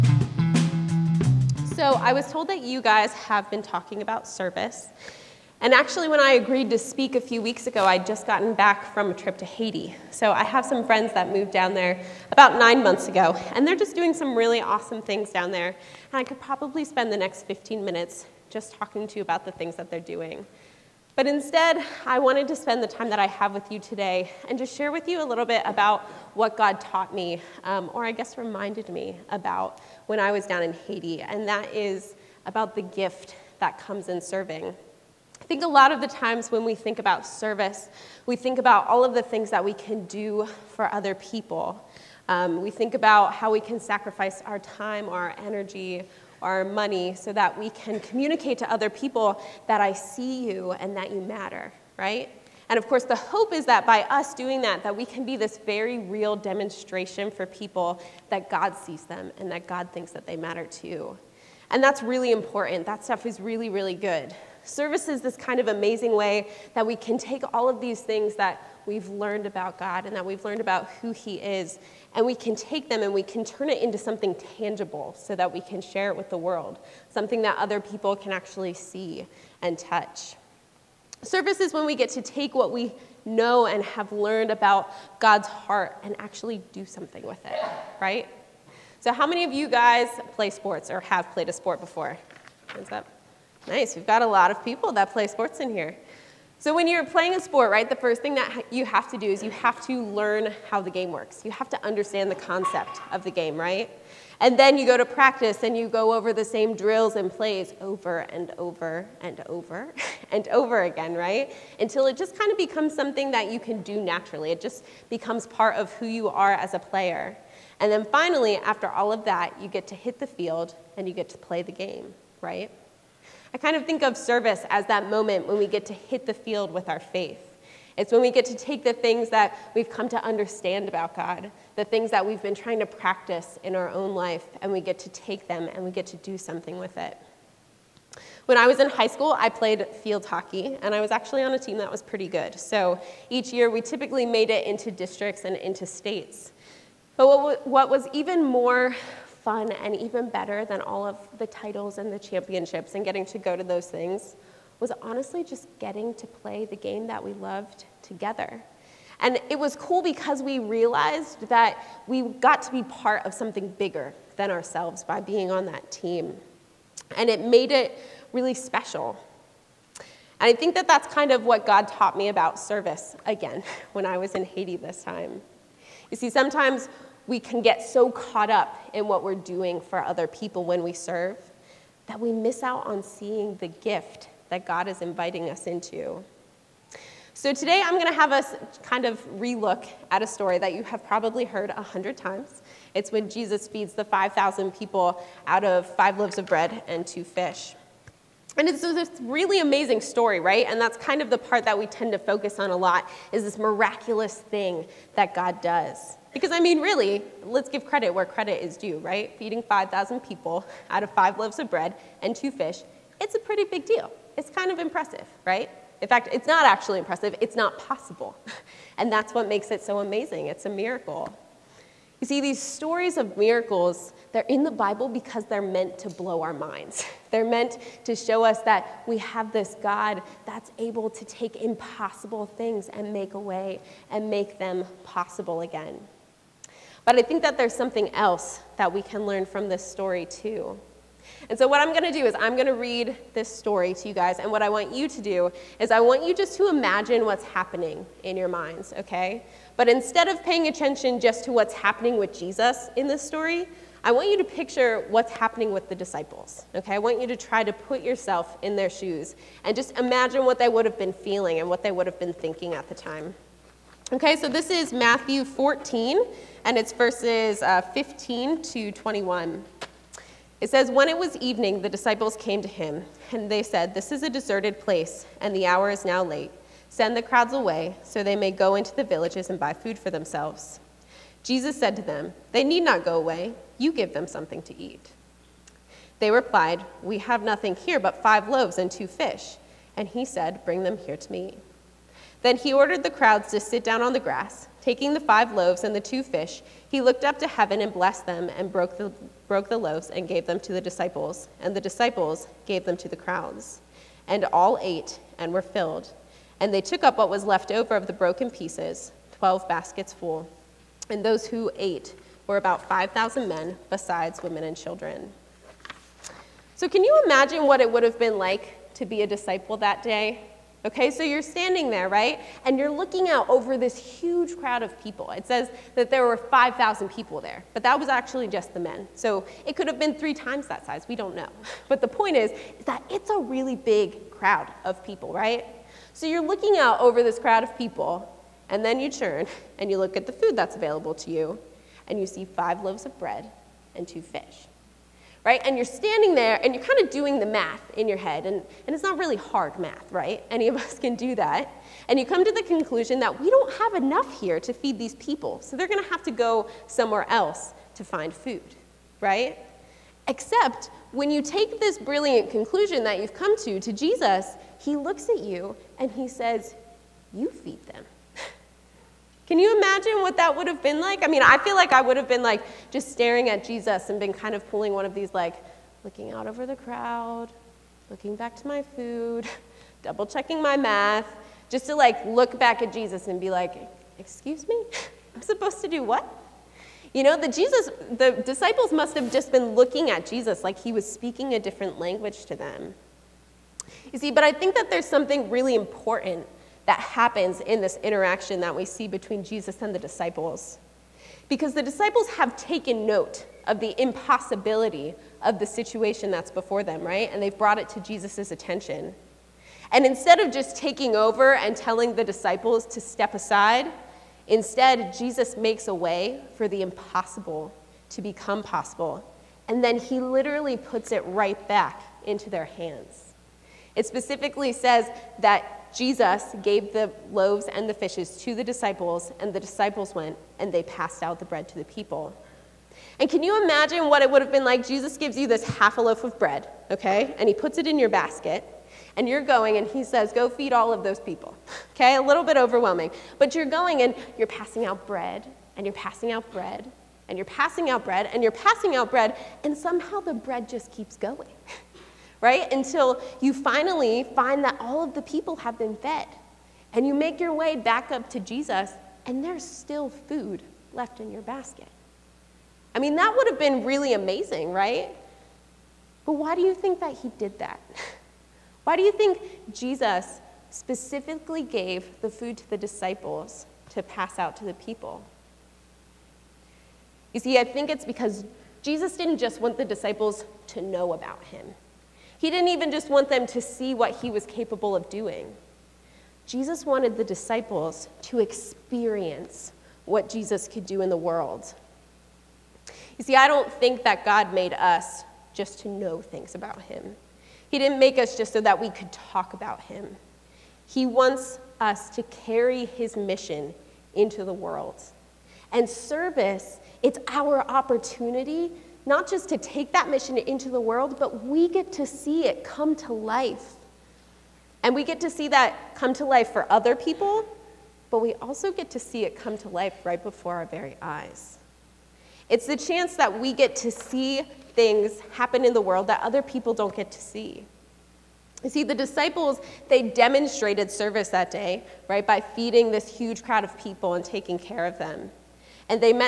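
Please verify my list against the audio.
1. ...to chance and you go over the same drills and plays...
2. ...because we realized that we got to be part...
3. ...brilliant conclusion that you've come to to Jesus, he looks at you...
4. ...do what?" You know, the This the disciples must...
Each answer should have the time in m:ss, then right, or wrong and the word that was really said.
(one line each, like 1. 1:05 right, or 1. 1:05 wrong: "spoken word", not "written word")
1. 1:44 wrong: "practice", not "chance"
2. 2:40 right
3. 6:01 right
4. 6:25 wrong: "Jesus", not "This".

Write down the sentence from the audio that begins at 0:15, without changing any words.
And I could probably spend the next 15 minutes just talking to you about the things that they're doing.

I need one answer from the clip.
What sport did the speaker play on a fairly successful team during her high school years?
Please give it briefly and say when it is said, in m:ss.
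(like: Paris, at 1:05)
field hockey, at 2:20.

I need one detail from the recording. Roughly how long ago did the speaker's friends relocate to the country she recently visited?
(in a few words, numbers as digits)
9 months.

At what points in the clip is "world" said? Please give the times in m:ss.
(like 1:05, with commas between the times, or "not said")
1:16, 8:11, 8:24, 8:30, 8:45.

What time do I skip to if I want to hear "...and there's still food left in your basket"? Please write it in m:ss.
7:39.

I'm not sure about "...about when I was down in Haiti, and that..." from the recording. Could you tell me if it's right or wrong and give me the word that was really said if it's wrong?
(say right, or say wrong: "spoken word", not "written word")
right.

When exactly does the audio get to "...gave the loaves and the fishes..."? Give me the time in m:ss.
7:06.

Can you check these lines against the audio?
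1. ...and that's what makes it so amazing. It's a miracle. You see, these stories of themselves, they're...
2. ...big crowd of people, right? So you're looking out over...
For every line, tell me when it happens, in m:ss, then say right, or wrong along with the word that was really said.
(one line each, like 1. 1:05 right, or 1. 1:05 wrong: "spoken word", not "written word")
1. 3:38 wrong: "miracles", not "themselves"
2. 5:33 right.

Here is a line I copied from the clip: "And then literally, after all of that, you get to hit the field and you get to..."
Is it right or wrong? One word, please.
wrong.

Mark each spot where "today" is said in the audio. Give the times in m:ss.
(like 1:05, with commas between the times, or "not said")
0:23, 3:07.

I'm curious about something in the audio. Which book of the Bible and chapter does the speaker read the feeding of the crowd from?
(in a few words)
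Matthew 14.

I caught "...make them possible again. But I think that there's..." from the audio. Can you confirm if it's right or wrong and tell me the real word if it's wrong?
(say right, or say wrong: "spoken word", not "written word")
right.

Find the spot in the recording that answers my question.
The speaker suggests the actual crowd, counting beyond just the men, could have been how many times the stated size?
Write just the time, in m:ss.
5:30.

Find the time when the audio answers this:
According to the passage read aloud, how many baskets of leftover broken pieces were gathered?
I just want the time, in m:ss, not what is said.
5:09.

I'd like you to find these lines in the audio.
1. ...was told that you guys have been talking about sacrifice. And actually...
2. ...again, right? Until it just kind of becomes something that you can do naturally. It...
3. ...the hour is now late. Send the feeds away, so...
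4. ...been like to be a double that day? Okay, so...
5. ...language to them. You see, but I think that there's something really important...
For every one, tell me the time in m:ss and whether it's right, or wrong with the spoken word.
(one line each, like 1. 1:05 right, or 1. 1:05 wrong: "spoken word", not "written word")
1. 0:02 wrong: "service", not "sacrifice"
2. 1:50 right
3. 4:35 wrong: "crowds", not "feeds"
4. 5:18 wrong: "disciple", not "double"
5. 6:32 right.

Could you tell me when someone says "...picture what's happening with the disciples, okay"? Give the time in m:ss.
4:14.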